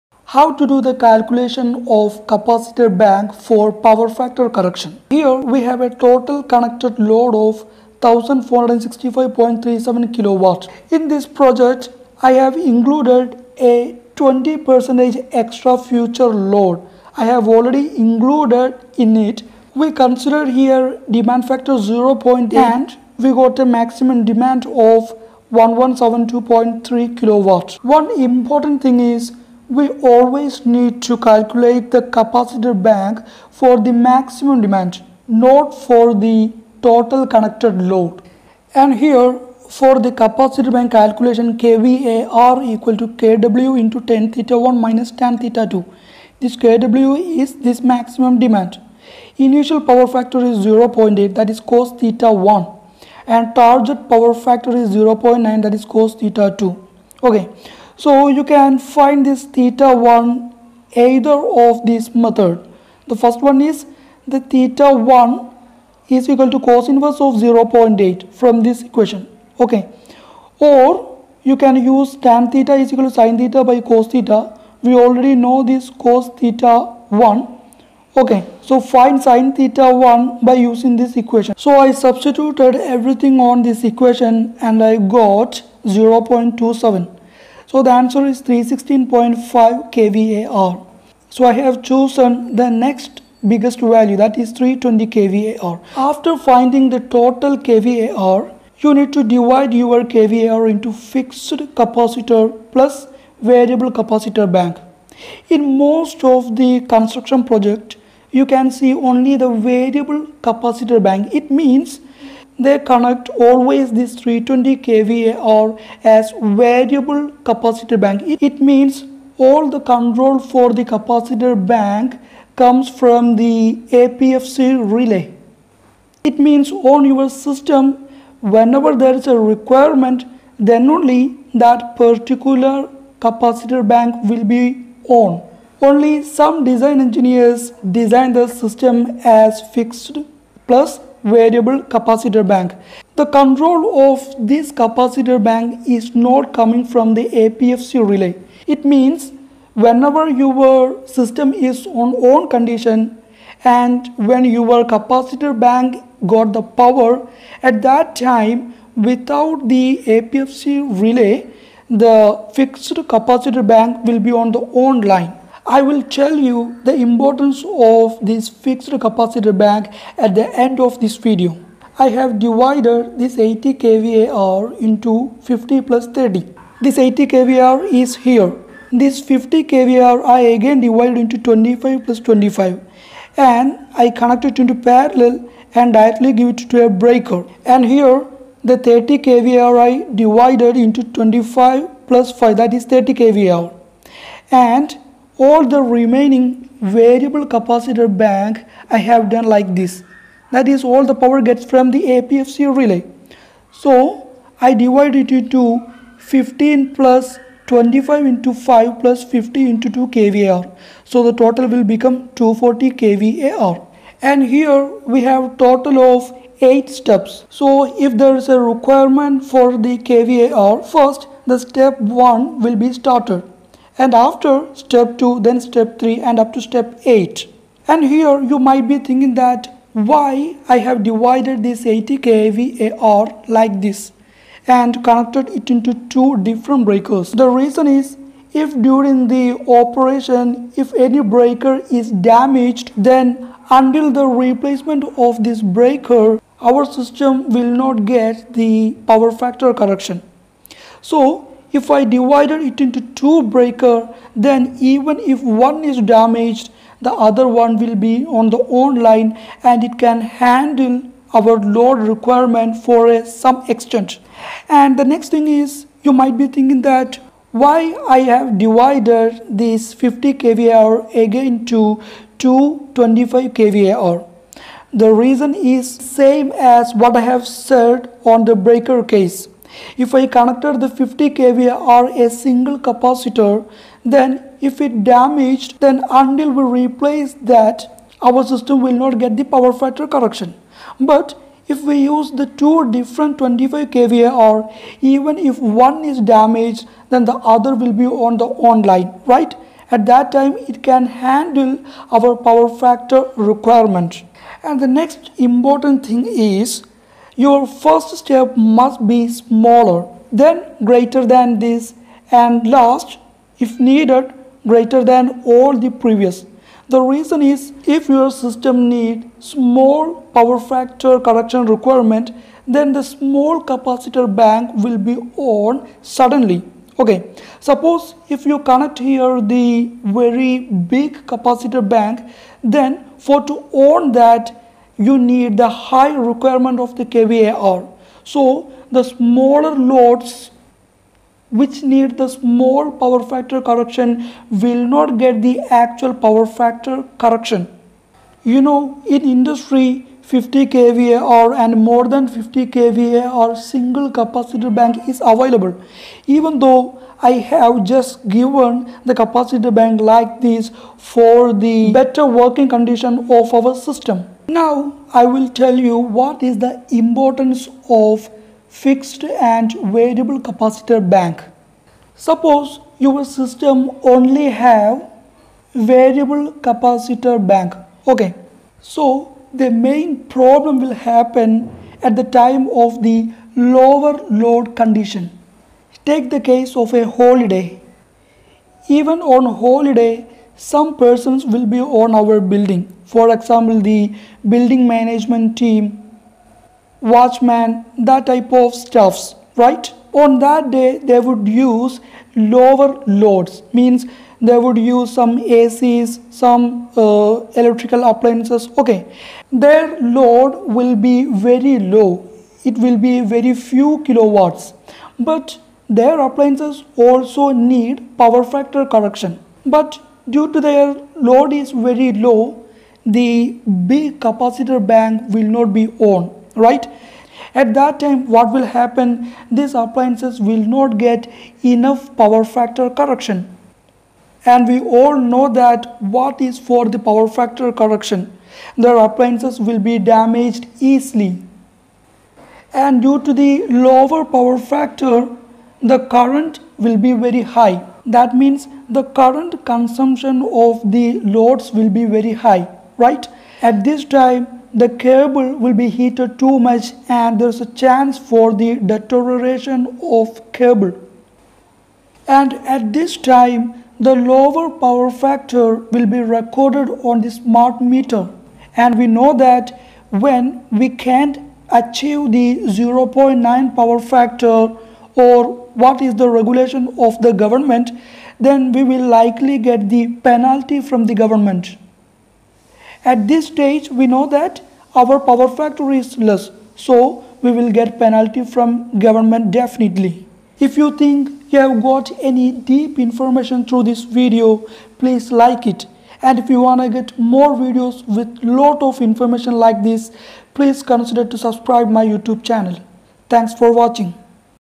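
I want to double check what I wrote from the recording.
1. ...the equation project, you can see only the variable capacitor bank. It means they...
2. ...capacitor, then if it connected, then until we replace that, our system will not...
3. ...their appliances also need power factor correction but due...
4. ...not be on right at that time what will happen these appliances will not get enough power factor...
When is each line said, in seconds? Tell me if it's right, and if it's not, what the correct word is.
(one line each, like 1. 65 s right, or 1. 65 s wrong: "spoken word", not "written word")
1. 106 s wrong: "construction", not "equation"
2. 282 s wrong: "damaged", not "connected"
3. 416 s right
4. 425 s right.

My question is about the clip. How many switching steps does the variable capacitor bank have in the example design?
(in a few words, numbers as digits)
8.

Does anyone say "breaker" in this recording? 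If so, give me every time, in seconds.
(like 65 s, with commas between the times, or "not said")
186 s, 236 s, 241 s, 245 s, 253 s, 278 s.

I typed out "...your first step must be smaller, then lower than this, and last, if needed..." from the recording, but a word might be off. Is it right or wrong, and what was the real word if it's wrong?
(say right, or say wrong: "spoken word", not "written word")
wrong: "greater", not "lower".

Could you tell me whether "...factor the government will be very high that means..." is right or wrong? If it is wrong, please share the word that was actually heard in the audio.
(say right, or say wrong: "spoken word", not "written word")
wrong: "current", not "government".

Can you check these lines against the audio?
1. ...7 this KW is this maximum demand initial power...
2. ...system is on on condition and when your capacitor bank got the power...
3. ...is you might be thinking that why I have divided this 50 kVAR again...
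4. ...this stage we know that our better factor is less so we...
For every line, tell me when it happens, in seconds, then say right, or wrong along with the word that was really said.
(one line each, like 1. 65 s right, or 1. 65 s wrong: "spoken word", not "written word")
1. 45 s wrong: "2", not "7"
2. 151 s right
3. 265 s right
4. 483 s wrong: "power", not "better".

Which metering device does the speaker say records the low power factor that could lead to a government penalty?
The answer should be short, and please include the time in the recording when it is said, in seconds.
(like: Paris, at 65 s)
smart meter, at 467 s.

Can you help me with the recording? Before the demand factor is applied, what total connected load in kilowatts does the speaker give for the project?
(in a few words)
1465.37 kW.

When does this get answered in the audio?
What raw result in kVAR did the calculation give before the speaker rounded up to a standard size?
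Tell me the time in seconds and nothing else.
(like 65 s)
88 s.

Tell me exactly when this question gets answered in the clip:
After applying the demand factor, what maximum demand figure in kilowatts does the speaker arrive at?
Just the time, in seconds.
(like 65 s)
25 s.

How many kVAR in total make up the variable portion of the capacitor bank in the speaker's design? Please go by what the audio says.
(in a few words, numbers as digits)
240 kVAR.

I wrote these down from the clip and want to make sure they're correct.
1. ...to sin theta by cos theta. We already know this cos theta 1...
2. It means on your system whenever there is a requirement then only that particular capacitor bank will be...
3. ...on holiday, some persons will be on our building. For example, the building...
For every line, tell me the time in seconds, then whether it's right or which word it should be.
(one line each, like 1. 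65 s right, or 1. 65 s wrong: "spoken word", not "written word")
1. 73 s right
2. 126 s right
3. 389 s right.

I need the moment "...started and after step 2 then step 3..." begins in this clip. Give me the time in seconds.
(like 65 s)
223 s.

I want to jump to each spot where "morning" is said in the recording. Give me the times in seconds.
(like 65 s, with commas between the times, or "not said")
not said.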